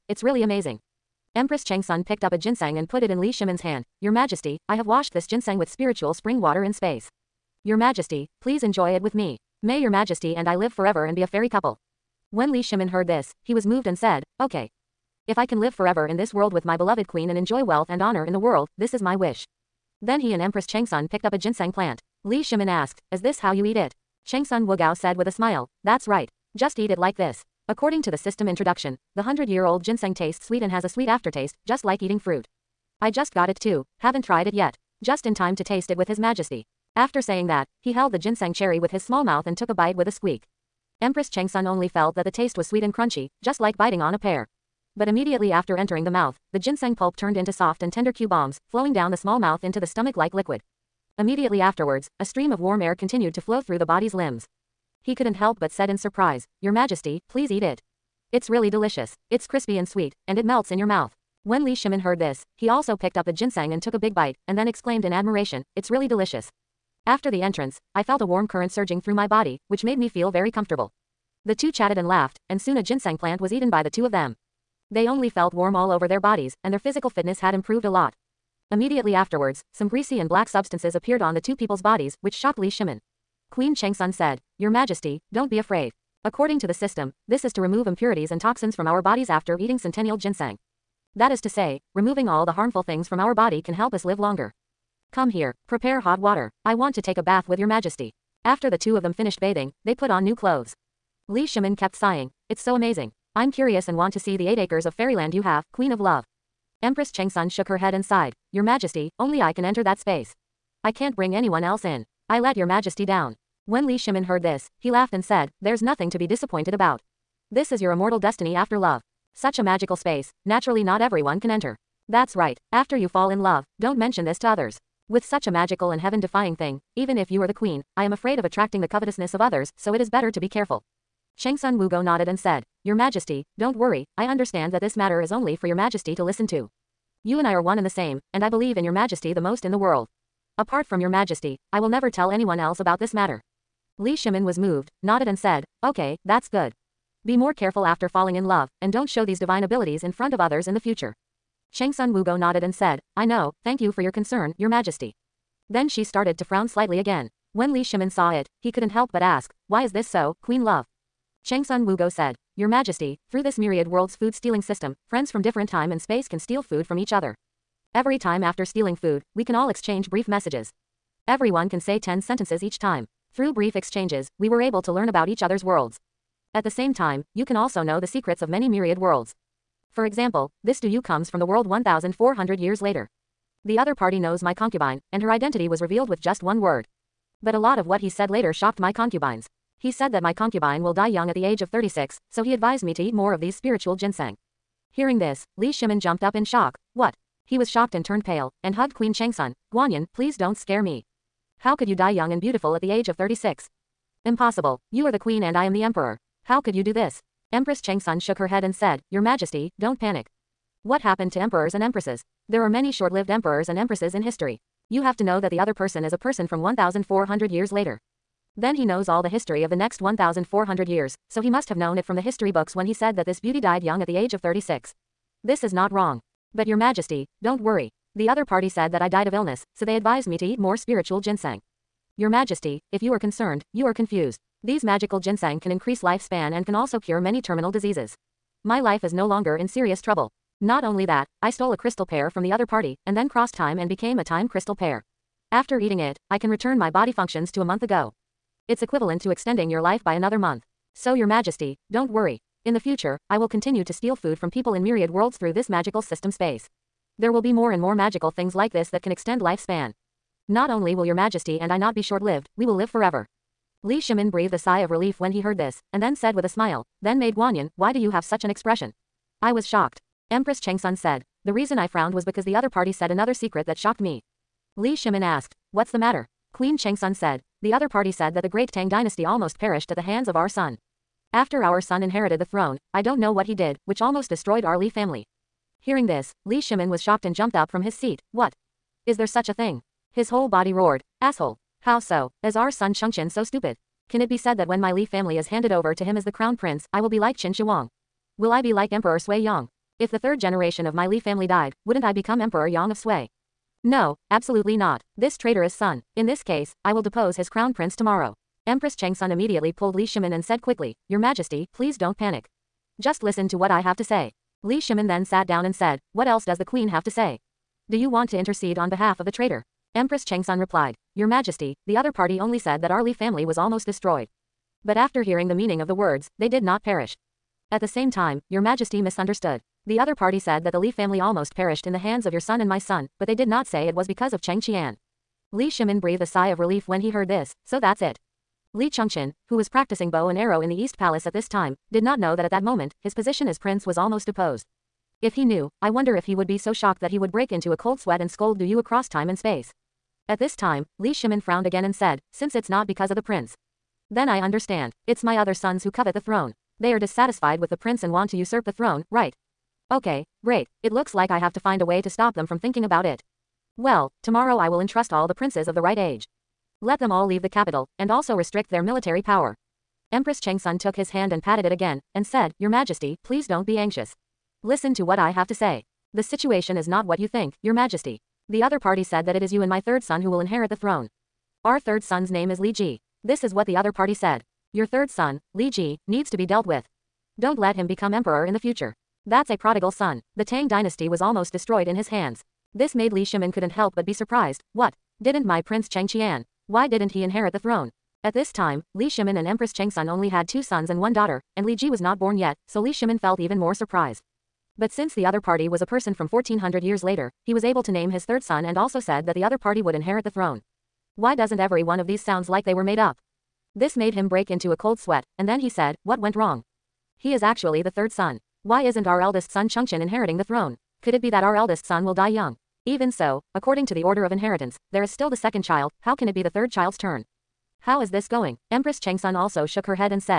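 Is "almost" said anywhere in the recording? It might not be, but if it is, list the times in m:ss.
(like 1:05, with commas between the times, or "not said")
4:39, 4:44, 5:23, 5:31, 5:43, 6:31.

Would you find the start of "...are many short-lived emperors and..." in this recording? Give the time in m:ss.
3:32.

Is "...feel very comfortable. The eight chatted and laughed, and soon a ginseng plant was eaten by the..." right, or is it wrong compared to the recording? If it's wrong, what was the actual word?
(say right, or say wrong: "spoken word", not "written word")
wrong: "two", not "eight".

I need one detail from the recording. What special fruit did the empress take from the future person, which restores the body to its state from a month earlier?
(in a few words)
time crystal pear.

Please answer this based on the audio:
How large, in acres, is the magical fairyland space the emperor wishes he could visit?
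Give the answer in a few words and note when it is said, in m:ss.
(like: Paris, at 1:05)
8 acres, at 1:44.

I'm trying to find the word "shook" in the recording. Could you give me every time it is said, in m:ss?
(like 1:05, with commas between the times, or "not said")
1:47, 3:28, 7:09.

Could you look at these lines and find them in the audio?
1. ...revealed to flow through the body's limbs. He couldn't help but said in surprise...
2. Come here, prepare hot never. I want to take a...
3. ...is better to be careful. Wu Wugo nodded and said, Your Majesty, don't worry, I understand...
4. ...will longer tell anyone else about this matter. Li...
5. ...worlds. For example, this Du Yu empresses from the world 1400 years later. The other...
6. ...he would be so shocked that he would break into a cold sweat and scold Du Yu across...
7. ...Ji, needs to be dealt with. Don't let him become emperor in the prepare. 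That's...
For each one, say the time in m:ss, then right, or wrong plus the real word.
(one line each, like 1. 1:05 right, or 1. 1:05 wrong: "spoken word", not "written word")
1. 0:52 wrong: "continued", not "revealed"
2. 1:35 wrong: "water", not "never"
3. 2:10 right
4. 2:21 wrong: "never", not "longer"
5. 2:58 wrong: "comes", not "empresses"
6. 5:46 right
7. 6:25 wrong: "future", not "prepare".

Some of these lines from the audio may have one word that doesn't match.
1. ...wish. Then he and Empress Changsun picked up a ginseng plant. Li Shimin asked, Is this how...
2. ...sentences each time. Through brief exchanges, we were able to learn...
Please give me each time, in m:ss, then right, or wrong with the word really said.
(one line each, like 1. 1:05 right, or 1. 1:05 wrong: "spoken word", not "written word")
1. 0:19 right
2. 2:52 right.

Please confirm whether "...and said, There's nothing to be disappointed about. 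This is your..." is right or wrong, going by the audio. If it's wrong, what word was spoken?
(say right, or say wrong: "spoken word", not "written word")
right.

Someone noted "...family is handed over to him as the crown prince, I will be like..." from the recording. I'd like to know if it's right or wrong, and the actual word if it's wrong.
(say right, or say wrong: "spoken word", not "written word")
right.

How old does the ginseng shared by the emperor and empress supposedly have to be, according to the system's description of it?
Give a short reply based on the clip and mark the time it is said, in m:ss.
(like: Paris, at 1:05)
100 years, at 0:29.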